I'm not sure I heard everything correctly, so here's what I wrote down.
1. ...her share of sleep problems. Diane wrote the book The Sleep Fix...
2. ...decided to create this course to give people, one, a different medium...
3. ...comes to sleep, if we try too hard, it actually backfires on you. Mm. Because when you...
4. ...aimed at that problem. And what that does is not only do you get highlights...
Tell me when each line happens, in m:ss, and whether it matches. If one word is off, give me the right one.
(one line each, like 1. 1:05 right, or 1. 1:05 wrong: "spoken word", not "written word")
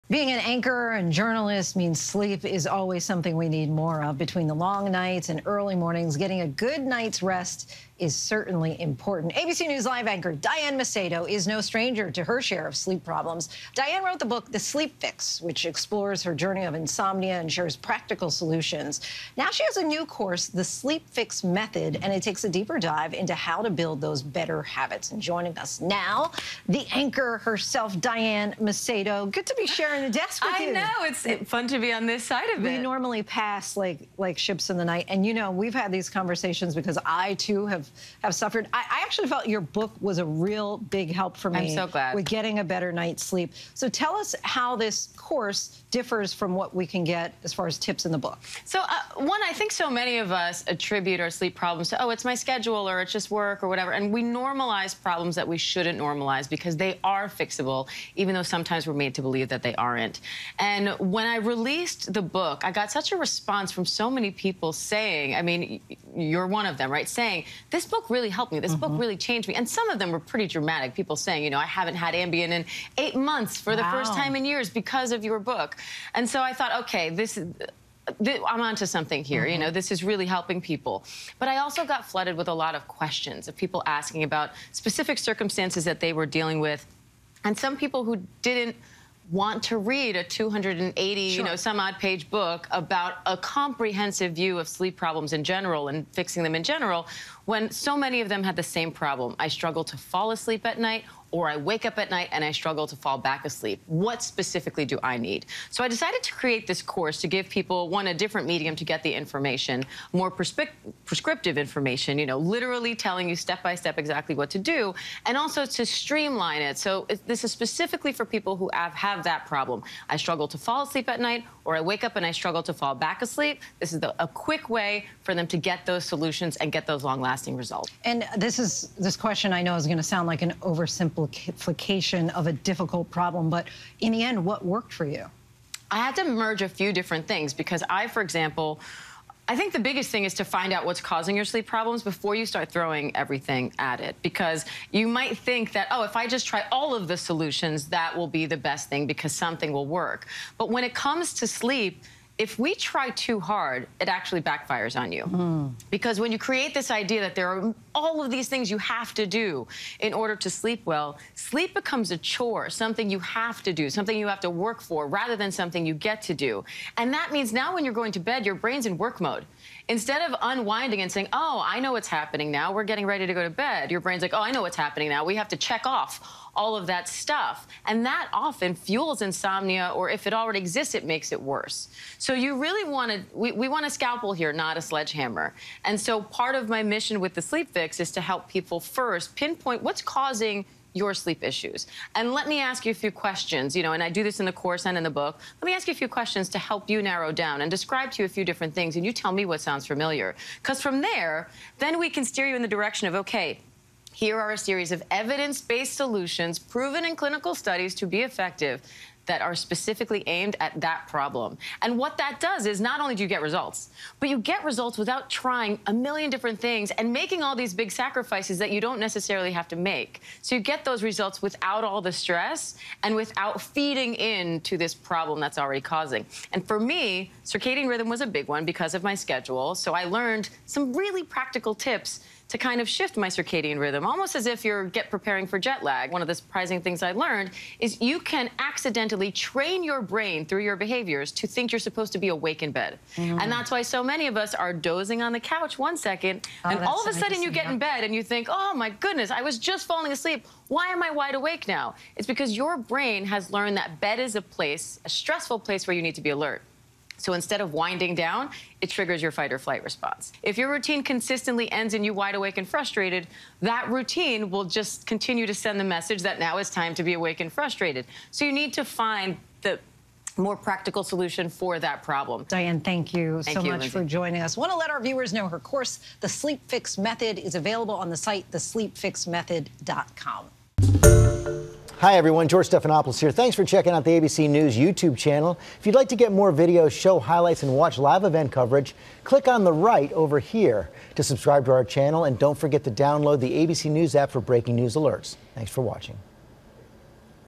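1. 0:12 right
2. 1:45 right
3. 2:30 right
4. 3:30 wrong: "results", not "highlights".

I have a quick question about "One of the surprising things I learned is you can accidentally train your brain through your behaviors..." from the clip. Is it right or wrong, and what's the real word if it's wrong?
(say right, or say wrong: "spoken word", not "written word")
right.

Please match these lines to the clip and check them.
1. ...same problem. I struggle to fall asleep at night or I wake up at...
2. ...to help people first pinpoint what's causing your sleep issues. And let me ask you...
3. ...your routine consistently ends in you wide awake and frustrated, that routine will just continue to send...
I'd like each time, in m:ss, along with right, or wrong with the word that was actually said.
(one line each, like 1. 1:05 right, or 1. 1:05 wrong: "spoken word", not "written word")
1. 1:38 right
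2. 3:08 right
3. 4:20 right.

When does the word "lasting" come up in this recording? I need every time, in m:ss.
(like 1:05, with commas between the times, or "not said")
2:07.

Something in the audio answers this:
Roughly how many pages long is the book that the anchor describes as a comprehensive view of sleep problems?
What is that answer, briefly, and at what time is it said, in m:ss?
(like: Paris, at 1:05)
280, at 1:30.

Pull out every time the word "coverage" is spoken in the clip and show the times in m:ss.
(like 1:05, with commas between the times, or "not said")
4:48.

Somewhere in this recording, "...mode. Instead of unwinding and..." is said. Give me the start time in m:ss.
2:49.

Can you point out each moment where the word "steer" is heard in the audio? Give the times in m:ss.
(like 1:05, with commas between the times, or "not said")
3:22.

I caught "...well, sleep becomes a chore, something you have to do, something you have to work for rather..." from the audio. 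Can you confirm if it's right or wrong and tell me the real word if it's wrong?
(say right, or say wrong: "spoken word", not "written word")
right.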